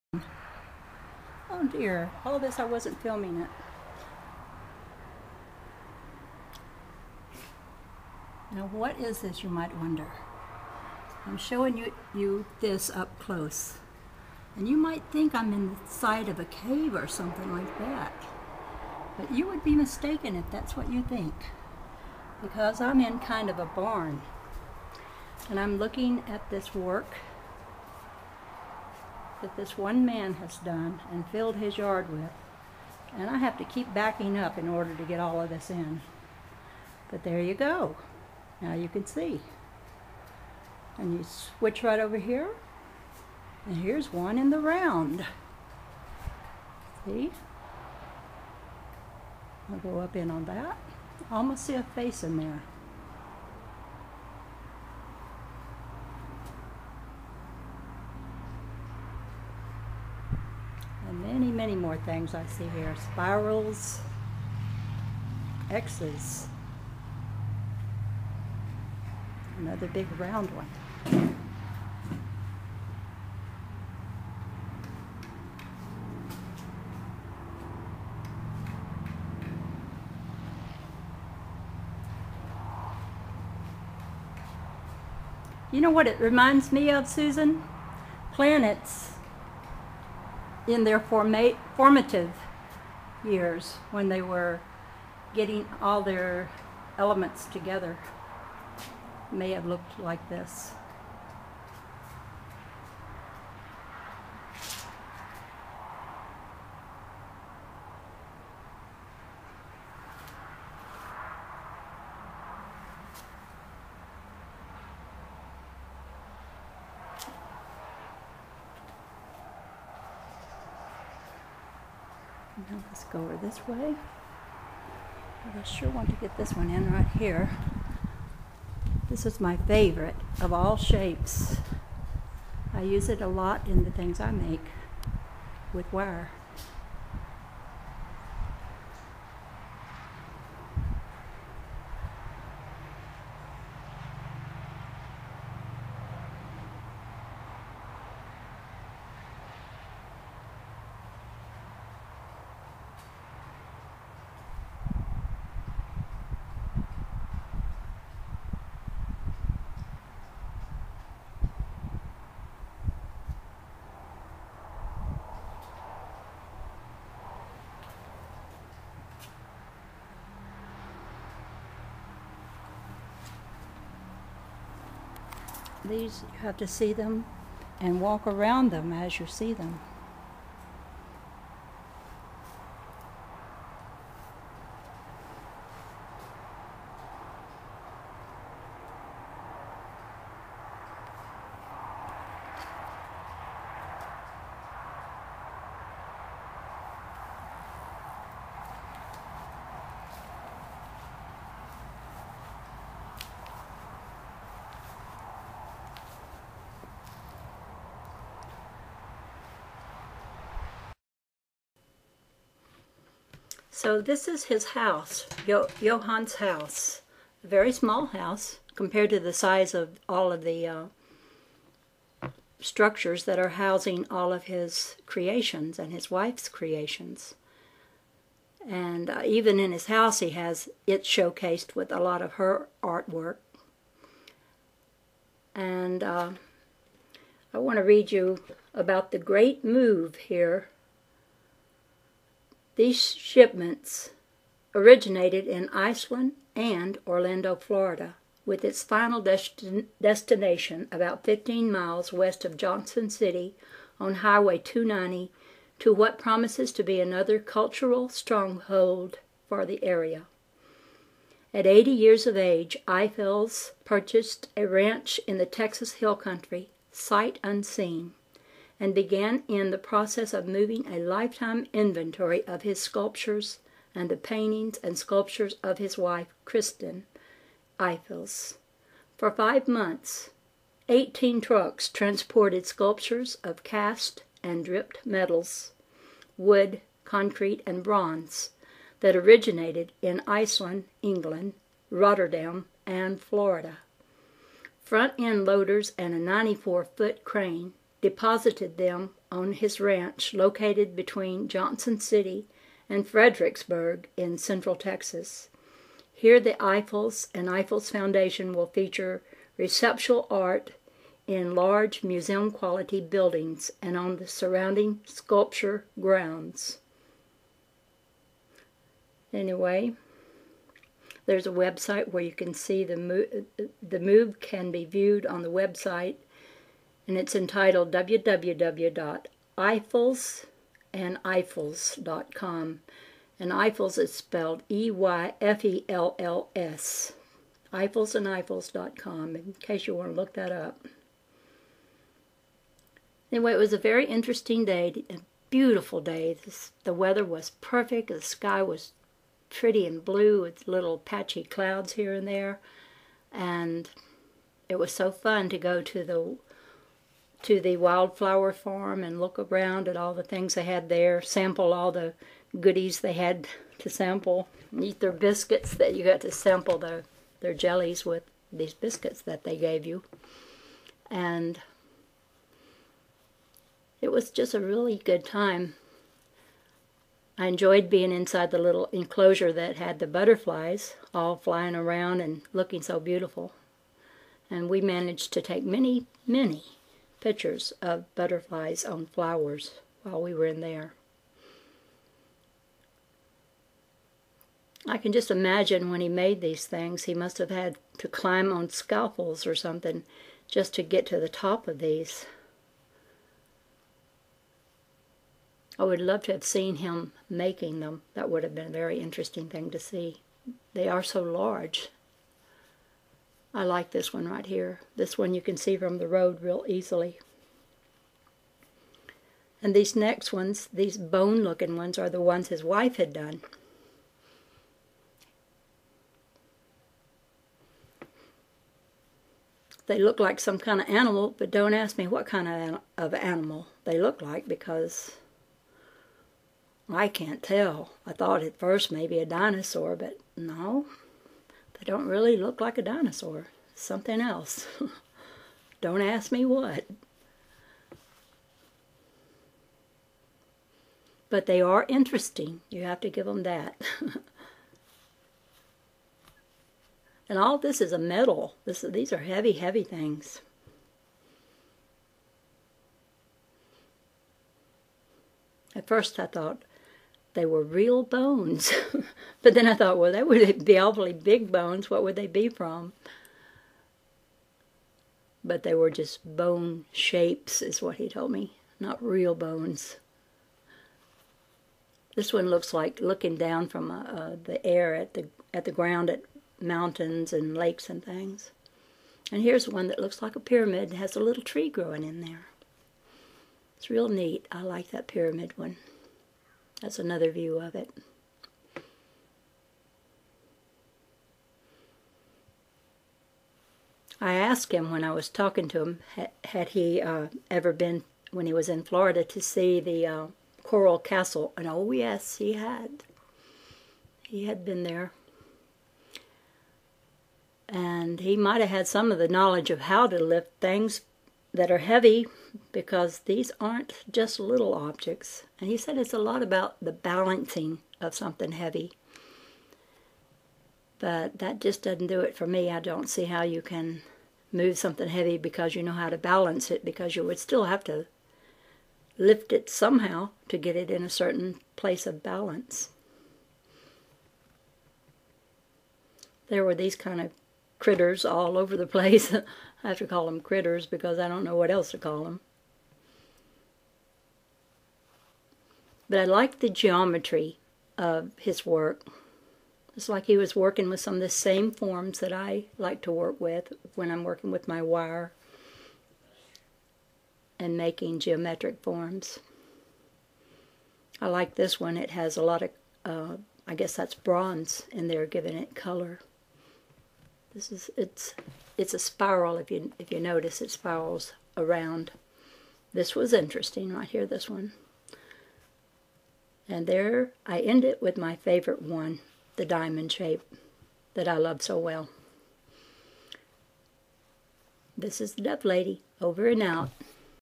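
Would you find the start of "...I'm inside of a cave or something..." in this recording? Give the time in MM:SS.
00:15.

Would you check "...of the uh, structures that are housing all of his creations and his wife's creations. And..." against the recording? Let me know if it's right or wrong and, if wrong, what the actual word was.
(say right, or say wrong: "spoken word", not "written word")
right.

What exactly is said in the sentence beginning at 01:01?
many more things I see here.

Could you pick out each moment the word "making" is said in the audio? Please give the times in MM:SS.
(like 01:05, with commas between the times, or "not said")
06:47, 09:27.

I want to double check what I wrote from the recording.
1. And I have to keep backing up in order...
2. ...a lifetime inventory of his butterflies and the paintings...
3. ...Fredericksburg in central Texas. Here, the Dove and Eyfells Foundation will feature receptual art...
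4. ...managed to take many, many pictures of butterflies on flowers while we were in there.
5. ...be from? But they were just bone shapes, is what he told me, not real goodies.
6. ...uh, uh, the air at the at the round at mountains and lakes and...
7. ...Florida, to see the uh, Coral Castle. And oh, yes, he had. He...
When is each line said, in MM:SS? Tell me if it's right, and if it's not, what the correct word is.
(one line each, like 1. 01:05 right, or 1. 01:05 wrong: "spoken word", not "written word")
1. 00:33 right
2. 04:30 wrong: "sculptures", not "butterflies"
3. 05:03 wrong: "Eyfells", not "Dove"
4. 06:24 right
5. 07:52 wrong: "bones", not "goodies"
6. 08:03 wrong: "ground", not "round"
7. 08:28 right.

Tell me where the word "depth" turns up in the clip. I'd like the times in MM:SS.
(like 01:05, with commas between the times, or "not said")
not said.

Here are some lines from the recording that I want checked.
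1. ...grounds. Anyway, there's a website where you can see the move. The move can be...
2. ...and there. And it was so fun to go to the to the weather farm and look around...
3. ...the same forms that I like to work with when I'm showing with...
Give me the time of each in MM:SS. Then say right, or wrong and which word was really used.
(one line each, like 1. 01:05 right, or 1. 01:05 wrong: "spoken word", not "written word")
1. 05:15 right
2. 05:52 wrong: "wildflower", not "weather"
3. 09:21 wrong: "working", not "showing".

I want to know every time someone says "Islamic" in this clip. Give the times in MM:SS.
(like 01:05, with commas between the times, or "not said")
not said.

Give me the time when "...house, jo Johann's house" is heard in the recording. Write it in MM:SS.
03:34.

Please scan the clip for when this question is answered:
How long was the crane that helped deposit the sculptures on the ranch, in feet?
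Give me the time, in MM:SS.
04:56.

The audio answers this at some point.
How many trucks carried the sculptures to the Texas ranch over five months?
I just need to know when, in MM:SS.
04:40.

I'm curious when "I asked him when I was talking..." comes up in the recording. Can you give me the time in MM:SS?
08:24.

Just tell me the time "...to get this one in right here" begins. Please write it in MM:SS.
02:06.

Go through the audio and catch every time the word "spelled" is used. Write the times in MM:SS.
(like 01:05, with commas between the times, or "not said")
05:34.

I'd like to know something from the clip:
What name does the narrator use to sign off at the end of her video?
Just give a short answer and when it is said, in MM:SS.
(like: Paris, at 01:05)
the Dove Lady, at 09:55.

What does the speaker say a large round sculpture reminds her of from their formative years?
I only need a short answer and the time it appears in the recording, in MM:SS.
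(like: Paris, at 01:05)
Planets, at 01:28.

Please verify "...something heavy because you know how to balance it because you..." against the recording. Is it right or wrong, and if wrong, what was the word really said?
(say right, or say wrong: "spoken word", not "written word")
right.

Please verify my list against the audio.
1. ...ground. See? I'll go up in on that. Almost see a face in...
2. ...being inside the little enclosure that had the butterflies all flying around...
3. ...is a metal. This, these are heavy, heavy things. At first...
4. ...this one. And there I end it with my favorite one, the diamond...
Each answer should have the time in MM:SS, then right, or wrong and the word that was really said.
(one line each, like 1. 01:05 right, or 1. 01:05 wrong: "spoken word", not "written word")
1. 00:44 wrong: "round", not "ground"
2. 06:17 right
3. 07:37 right
4. 09:44 right.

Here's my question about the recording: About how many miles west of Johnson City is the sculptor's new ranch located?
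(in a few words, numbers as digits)
15.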